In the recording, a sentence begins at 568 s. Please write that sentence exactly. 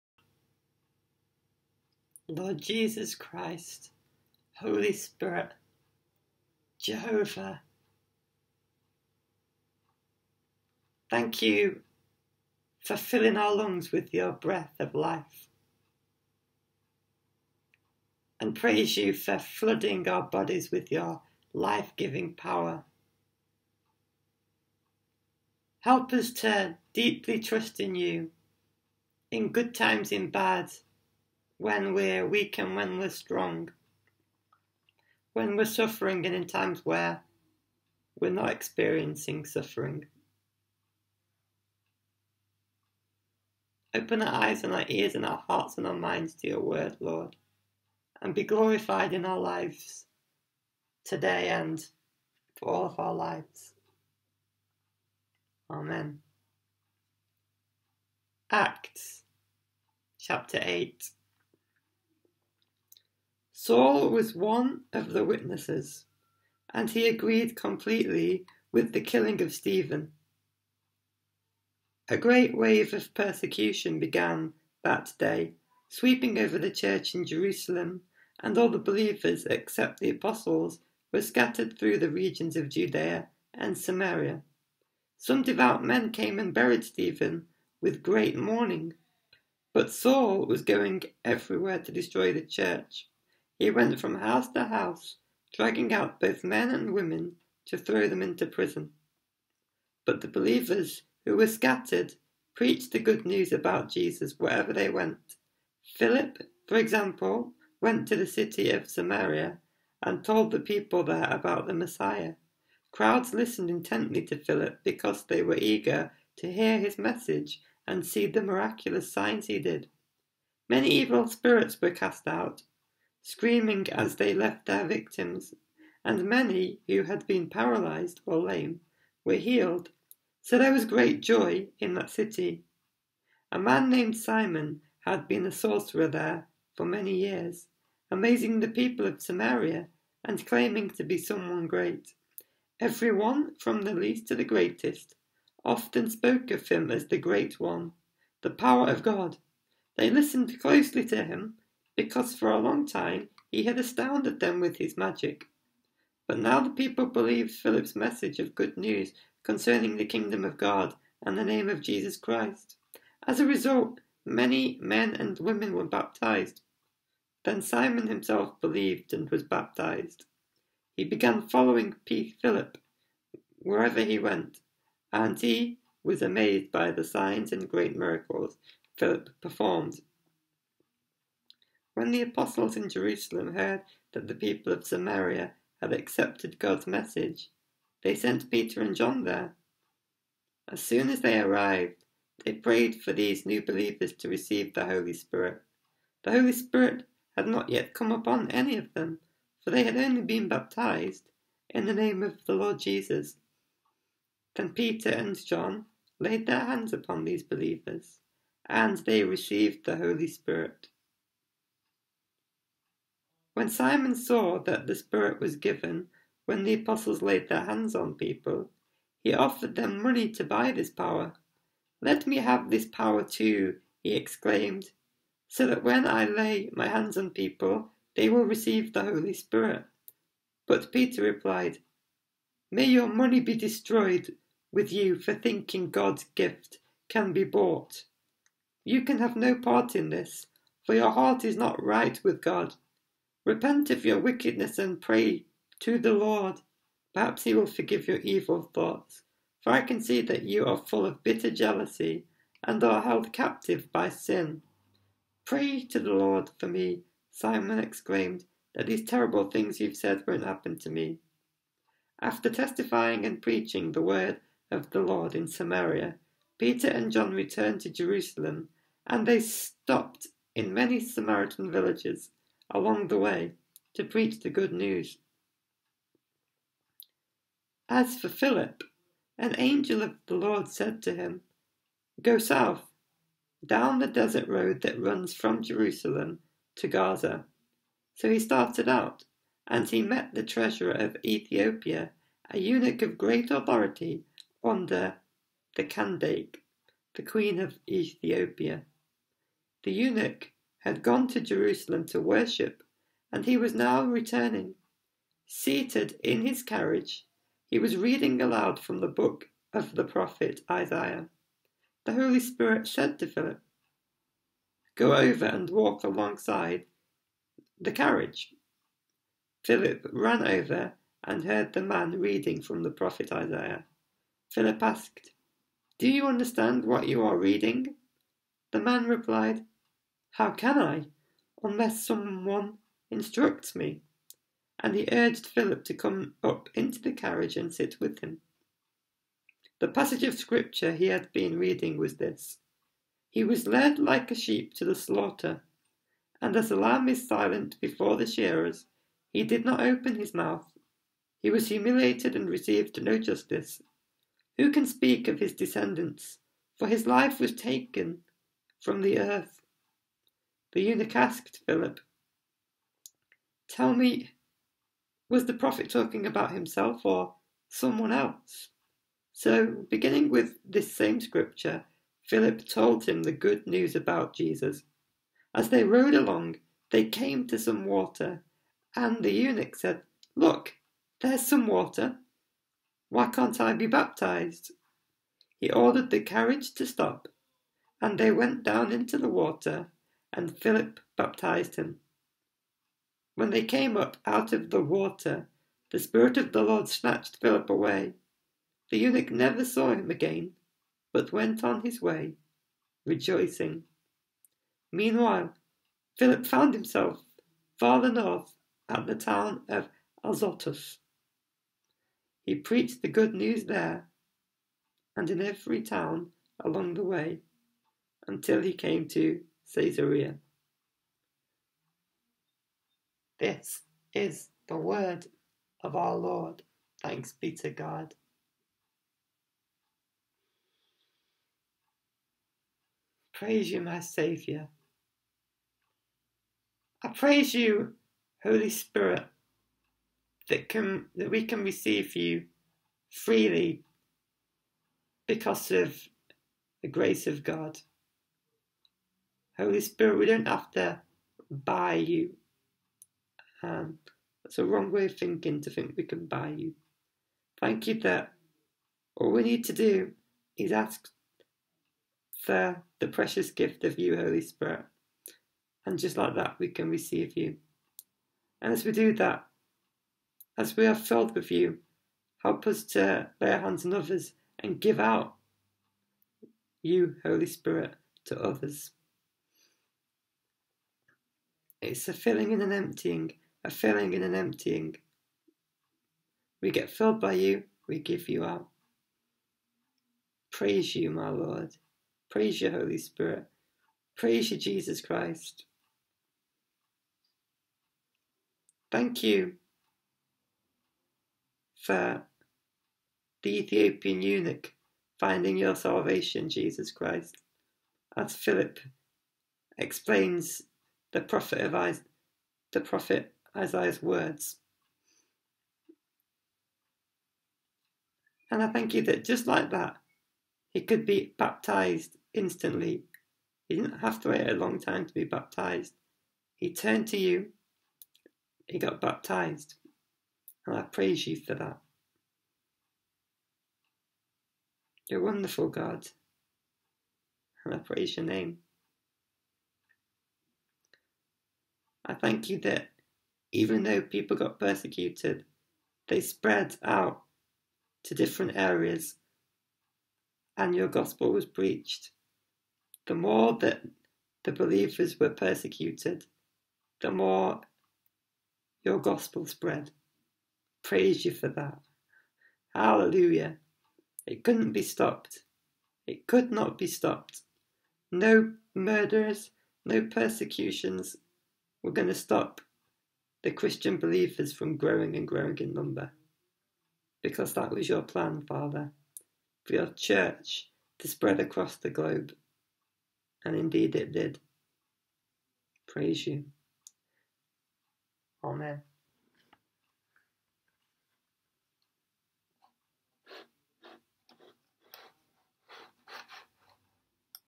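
No murders, no persecutions, we're going to stop the Christian believers from growing and growing in number.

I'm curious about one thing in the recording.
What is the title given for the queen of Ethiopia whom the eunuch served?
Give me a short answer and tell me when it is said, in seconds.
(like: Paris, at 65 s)
Kandake, at 295 s.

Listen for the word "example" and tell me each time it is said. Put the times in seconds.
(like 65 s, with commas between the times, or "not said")
106 s.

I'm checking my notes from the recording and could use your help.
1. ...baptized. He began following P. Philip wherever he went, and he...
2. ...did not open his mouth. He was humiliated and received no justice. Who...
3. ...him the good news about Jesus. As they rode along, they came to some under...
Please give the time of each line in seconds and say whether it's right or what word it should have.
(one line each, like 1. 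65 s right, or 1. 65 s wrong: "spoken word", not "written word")
1. 169 s right
2. 349 s right
3. 373 s wrong: "water", not "under".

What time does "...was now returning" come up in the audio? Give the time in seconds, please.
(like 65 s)
303 s.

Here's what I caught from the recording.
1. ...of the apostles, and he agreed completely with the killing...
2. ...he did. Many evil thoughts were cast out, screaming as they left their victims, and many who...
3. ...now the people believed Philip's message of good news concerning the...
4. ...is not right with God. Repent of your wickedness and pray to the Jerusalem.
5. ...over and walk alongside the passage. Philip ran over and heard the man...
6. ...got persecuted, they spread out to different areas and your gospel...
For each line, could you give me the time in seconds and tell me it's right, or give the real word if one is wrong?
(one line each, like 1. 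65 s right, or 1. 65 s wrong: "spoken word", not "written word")
1. 64 s wrong: "witnesses", not "apostles"
2. 119 s wrong: "spirits", not "thoughts"
3. 156 s right
4. 241 s wrong: "Lord", not "Jerusalem"
5. 315 s wrong: "carriage", not "passage"
6. 544 s right.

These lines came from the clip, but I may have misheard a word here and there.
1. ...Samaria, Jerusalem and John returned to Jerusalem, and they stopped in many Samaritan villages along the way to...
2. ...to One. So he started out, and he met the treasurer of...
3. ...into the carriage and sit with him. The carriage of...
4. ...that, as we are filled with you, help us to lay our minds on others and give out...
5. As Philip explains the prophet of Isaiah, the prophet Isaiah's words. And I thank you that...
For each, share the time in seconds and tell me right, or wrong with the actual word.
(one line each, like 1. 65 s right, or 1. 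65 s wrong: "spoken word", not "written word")
1. 265 s wrong: "Peter", not "Jerusalem"
2. 286 s wrong: "Gaza", not "One"
3. 336 s wrong: "passage", not "carriage"
4. 469 s wrong: "hands", not "minds"
5. 508 s right.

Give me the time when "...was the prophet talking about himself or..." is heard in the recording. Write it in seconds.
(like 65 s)
365 s.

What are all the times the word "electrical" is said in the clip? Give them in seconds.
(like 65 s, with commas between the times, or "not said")
not said.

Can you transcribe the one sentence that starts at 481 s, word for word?
It's a filling and an emptying, a filling and an emptying.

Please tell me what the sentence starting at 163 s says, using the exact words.
As a result, many men and women were baptized.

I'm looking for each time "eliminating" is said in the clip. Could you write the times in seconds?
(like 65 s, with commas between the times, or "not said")
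not said.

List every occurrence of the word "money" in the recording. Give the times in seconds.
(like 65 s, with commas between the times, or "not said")
220 s, 233 s.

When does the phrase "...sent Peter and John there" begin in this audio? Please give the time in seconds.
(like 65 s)
188 s.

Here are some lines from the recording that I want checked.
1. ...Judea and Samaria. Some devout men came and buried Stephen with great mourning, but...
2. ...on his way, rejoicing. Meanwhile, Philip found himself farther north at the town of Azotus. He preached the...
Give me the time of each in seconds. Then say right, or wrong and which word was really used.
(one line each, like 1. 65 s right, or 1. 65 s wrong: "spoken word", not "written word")
1. 82 s right
2. 401 s right.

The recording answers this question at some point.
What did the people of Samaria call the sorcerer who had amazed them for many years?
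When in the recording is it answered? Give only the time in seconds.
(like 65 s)
147 s.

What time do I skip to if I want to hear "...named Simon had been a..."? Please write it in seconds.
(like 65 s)
133 s.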